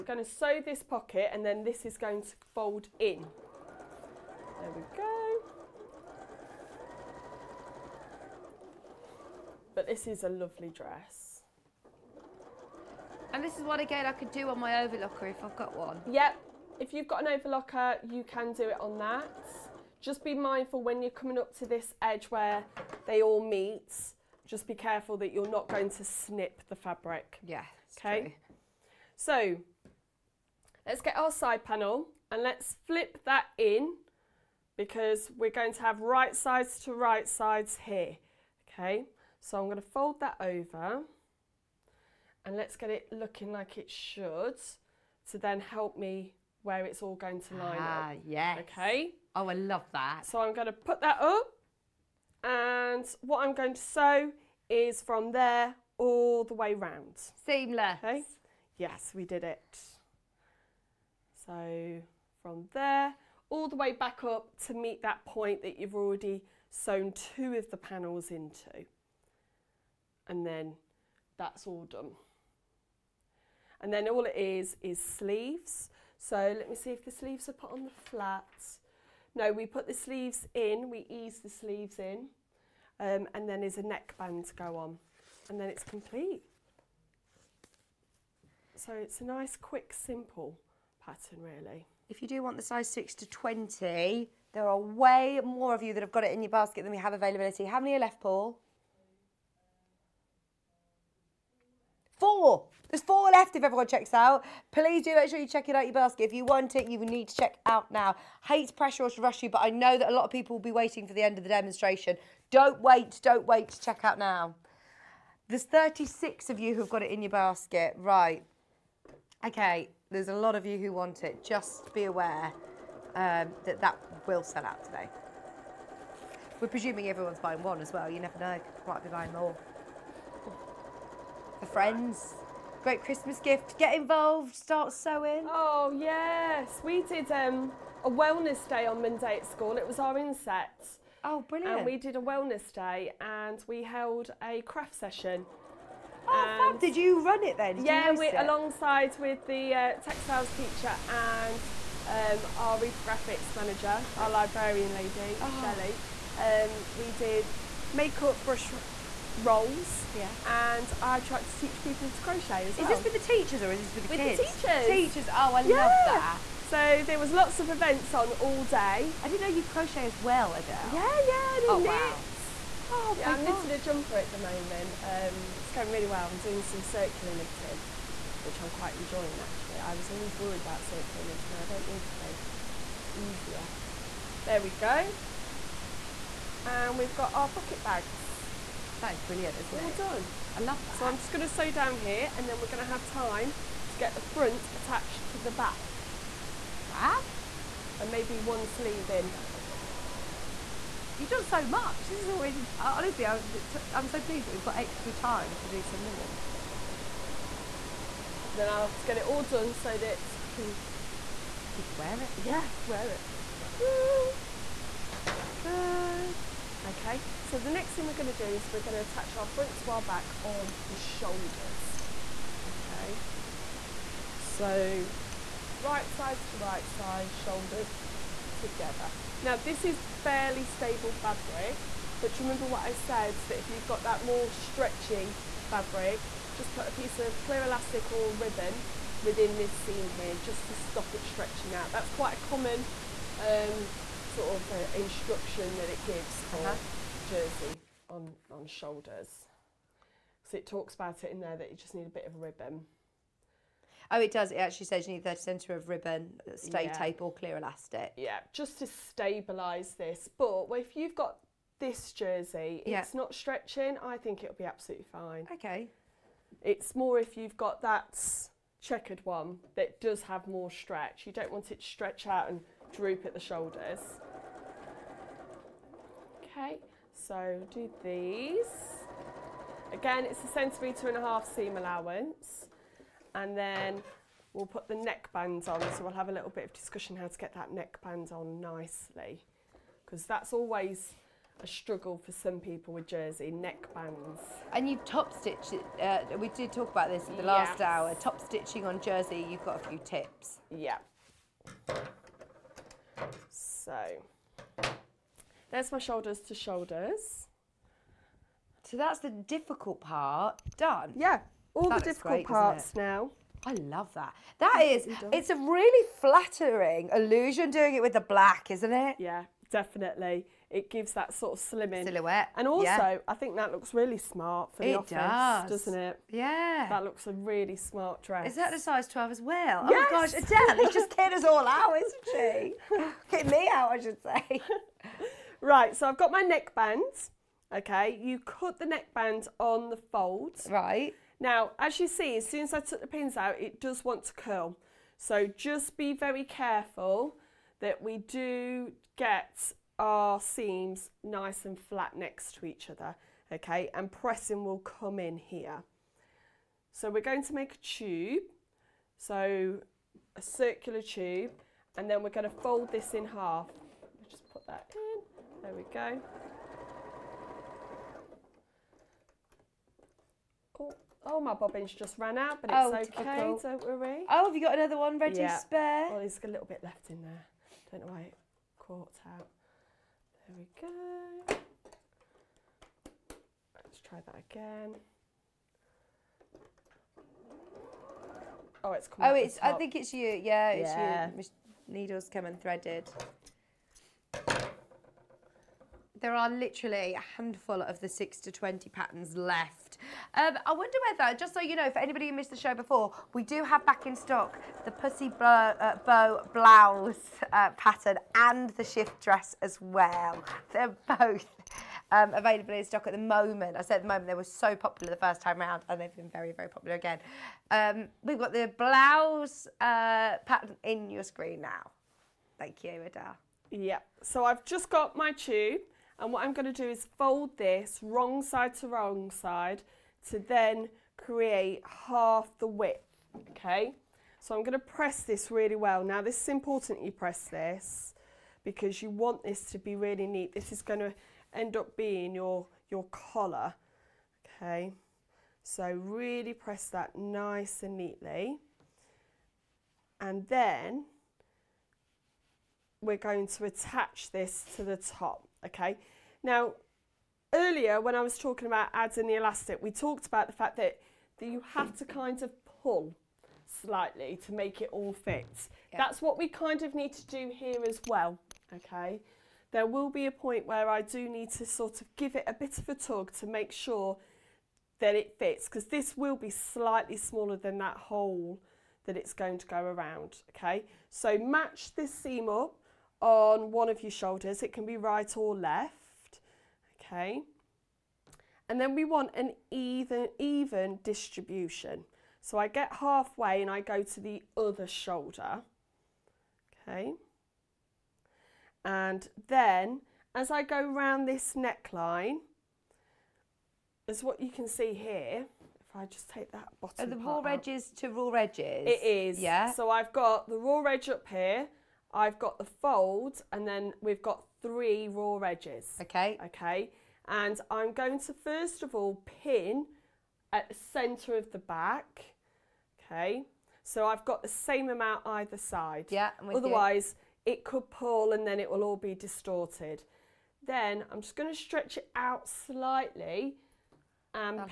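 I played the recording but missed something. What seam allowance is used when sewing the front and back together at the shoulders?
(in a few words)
1.5 centimetres.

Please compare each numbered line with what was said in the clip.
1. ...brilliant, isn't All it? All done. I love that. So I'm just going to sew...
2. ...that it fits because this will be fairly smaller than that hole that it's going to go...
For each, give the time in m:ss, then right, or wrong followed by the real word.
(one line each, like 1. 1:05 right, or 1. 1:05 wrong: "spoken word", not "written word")
1. 3:09 right
2. 7:54 wrong: "slightly", not "fairly".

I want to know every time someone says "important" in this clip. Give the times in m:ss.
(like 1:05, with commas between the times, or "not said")
7:16.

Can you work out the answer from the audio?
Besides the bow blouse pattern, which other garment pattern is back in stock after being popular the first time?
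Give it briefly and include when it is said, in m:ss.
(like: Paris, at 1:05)
Shift dress, at 6:48.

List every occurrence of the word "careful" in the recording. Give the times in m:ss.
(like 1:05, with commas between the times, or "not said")
0:24, 5:46.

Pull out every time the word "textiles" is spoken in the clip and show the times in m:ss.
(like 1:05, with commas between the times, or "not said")
2:30.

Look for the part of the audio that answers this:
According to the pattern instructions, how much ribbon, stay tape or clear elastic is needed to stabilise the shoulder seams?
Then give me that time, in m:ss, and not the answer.
4:15.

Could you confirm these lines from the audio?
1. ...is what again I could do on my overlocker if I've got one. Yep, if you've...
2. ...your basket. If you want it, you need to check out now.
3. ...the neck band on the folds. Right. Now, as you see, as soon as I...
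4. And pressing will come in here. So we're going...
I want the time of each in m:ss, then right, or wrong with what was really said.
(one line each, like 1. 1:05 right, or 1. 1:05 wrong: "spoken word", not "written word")
1. 0:13 right
2. 1:45 right
3. 5:38 right
4. 5:53 right.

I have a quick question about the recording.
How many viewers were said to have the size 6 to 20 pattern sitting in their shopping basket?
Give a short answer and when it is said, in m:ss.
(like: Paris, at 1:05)
36, at 1:55.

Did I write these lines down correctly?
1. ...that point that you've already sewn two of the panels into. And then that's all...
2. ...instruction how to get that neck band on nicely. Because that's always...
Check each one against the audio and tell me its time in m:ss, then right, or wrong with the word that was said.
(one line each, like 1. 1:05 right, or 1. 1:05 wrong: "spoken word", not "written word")
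1. 1:05 right
2. 4:46 wrong: "discussion", not "instruction".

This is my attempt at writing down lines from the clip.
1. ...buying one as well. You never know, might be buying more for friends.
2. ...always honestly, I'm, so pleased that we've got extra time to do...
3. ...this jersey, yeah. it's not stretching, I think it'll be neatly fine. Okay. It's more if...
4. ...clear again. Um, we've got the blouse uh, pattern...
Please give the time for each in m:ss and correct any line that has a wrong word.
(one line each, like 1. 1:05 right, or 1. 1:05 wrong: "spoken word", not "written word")
1. 2:07 right
2. 3:22 right
3. 4:21 wrong: "absolutely", not "neatly"
4. 6:56 wrong: "popular", not "clear".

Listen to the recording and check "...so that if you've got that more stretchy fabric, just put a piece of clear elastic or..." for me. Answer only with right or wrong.
right.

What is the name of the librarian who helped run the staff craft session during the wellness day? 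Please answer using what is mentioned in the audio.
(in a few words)
Shelley.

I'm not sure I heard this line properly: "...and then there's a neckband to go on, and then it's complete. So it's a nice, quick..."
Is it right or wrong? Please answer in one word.
right.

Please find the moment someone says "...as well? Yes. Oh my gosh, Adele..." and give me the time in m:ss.
5:29.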